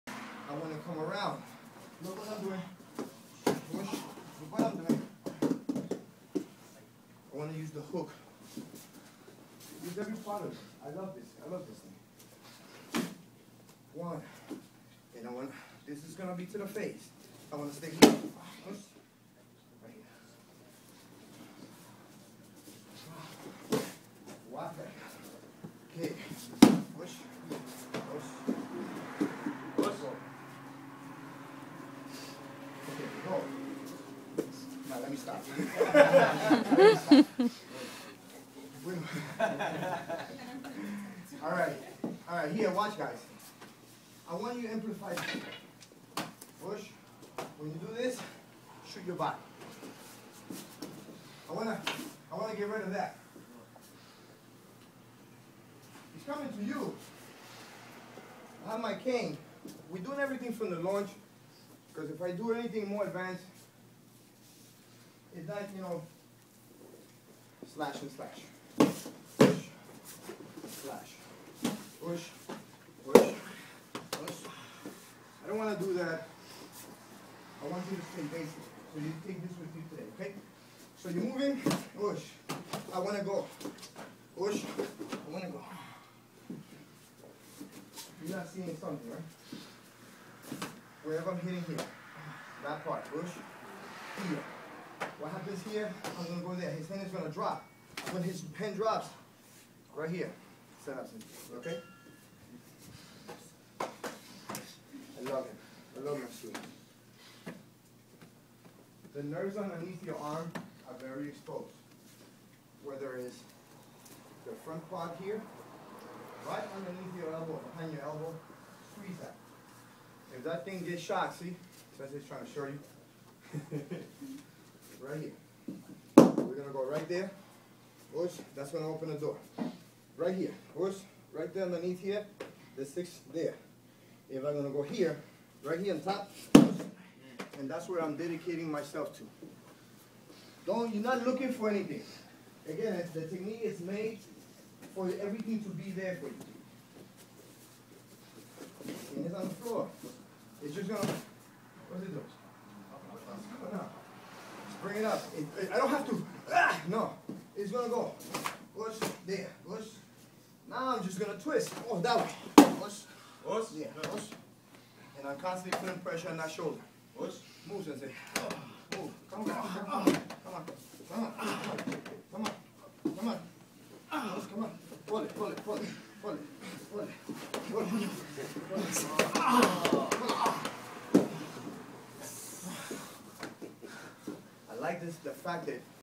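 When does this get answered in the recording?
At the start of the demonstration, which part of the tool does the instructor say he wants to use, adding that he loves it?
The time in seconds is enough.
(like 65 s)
7 s.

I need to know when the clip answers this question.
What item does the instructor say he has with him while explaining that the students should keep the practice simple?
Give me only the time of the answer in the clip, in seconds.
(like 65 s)
58 s.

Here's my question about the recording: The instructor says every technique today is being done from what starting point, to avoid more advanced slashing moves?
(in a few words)
the launch.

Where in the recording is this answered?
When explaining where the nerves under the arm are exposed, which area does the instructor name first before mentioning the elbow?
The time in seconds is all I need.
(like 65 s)
114 s.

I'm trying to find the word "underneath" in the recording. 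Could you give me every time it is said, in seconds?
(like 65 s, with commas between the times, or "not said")
109 s, 116 s, 131 s.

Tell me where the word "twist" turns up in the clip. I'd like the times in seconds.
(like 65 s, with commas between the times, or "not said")
161 s.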